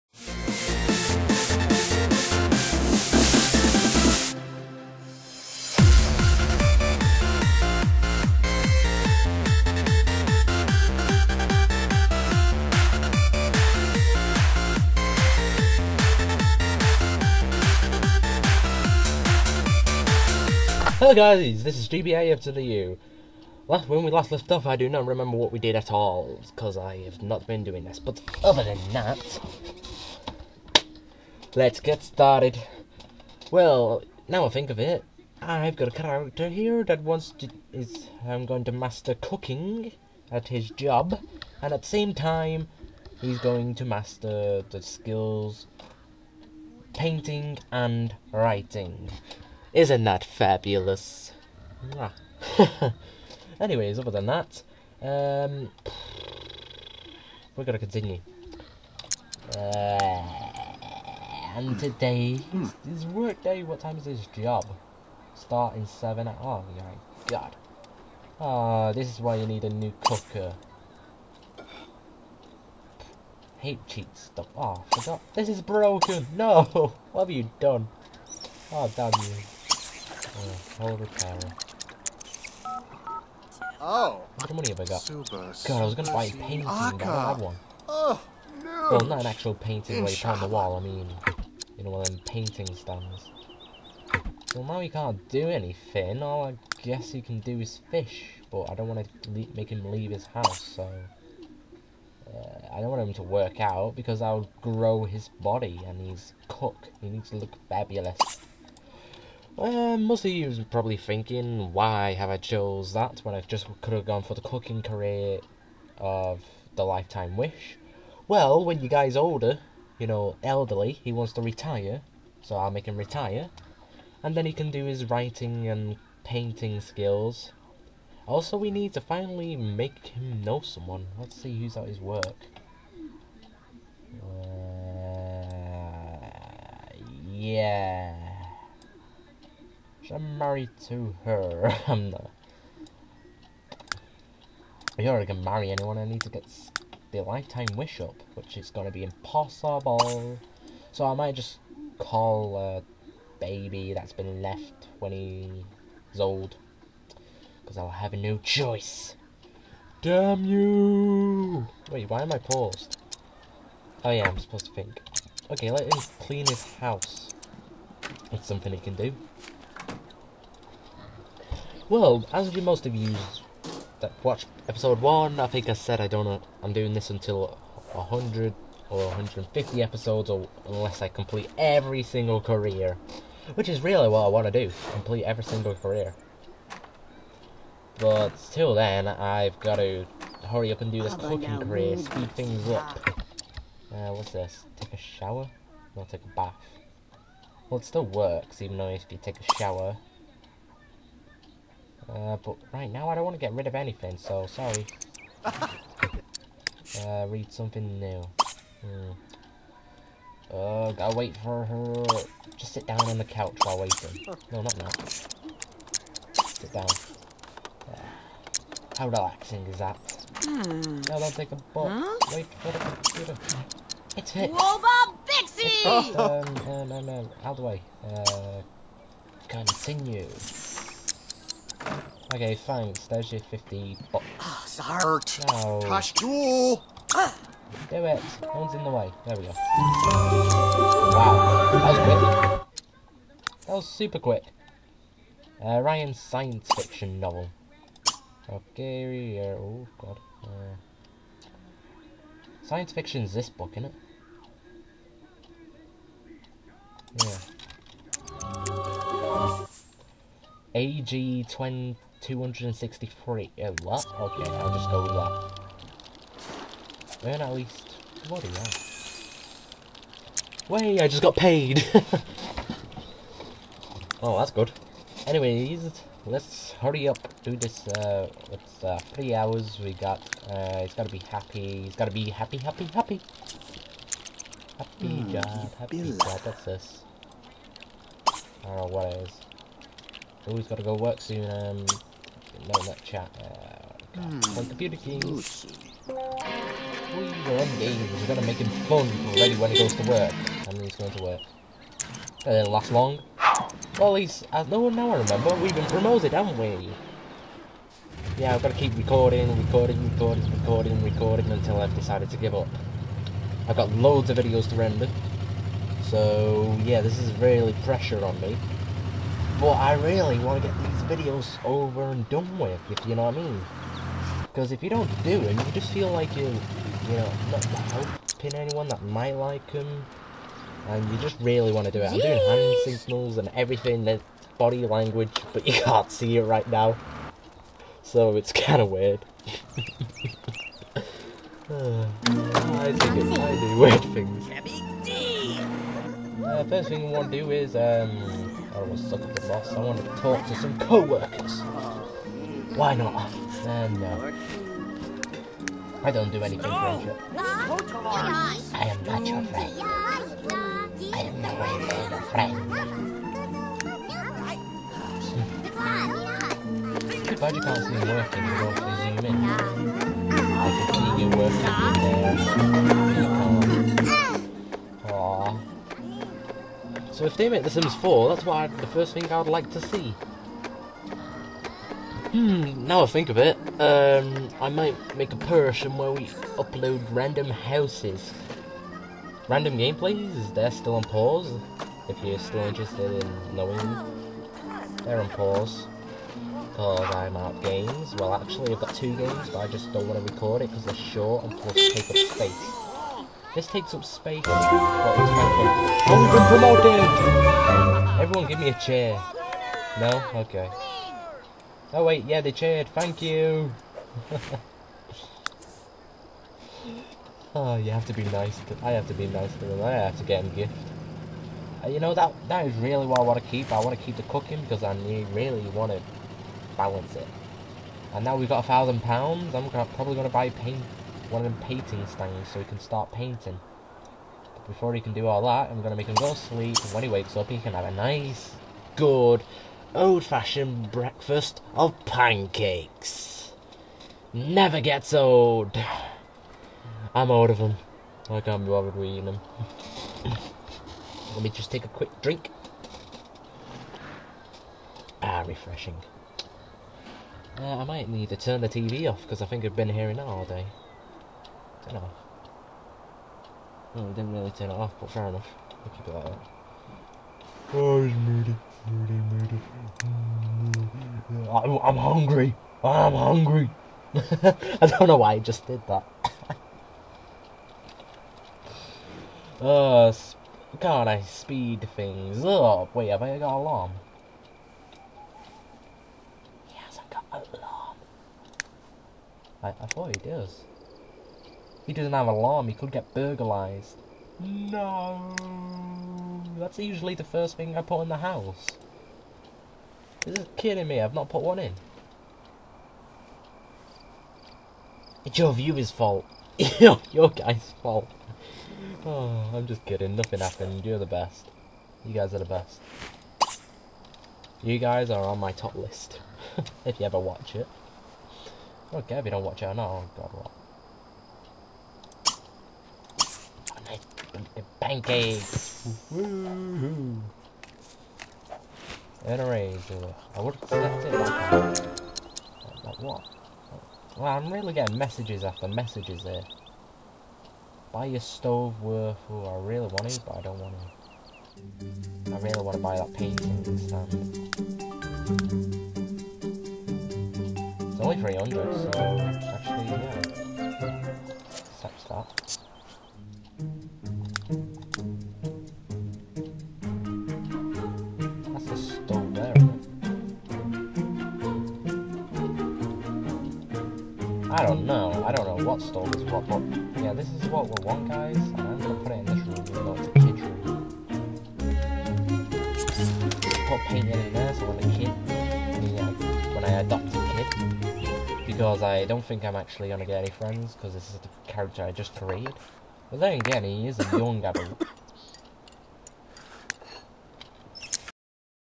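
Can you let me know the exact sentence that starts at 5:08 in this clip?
Yeah, I've got to keep recording, recording, recording, recording, recording until I've decided to give up.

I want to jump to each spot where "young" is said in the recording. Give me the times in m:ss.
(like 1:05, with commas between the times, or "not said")
9:44.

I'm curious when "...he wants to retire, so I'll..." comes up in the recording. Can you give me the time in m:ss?
2:01.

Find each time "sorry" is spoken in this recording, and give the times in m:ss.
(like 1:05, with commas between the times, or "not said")
3:24, 3:54.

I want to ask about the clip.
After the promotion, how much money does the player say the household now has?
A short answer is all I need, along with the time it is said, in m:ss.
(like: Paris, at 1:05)
1000 pounds, at 7:08.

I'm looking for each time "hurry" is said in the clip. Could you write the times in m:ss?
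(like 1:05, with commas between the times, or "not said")
3:10, 4:36.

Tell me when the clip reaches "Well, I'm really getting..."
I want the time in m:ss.
8:54.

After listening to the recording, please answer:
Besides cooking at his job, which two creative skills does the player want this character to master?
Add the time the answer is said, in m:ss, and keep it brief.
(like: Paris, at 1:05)
painting and writing, at 0:46.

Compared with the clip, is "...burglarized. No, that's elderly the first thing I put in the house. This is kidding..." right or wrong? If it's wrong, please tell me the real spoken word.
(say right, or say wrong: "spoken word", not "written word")
wrong: "usually", not "elderly".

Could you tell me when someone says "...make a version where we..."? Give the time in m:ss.
6:25.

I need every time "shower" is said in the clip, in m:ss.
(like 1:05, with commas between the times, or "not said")
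3:14, 3:19.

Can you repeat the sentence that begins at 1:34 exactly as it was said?
Well, now he can't do anything.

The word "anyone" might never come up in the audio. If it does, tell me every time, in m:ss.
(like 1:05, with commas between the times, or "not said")
2:25, 5:28.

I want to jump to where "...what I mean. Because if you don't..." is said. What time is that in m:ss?
5:23.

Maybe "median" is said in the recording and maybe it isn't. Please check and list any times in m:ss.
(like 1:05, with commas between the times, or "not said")
not said.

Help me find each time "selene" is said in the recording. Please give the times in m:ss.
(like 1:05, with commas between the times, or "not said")
not said.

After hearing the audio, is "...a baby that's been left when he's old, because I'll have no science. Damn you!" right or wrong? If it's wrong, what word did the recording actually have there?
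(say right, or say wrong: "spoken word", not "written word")
wrong: "choice", not "science".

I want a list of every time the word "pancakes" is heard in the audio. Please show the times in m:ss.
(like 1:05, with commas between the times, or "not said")
7:22, 8:44.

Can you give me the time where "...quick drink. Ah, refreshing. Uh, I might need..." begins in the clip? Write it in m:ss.
7:31.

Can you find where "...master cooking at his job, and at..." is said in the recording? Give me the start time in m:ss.
0:38.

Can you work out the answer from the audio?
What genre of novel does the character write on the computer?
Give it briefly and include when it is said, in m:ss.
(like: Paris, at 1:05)
science fiction, at 4:06.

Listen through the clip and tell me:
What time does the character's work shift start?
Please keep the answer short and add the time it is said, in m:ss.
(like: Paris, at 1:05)
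7, at 1:05.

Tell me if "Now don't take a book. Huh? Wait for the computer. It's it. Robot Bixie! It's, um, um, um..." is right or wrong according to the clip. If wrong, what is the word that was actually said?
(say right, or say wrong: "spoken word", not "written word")
right.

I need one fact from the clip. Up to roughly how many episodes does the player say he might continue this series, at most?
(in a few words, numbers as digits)
150.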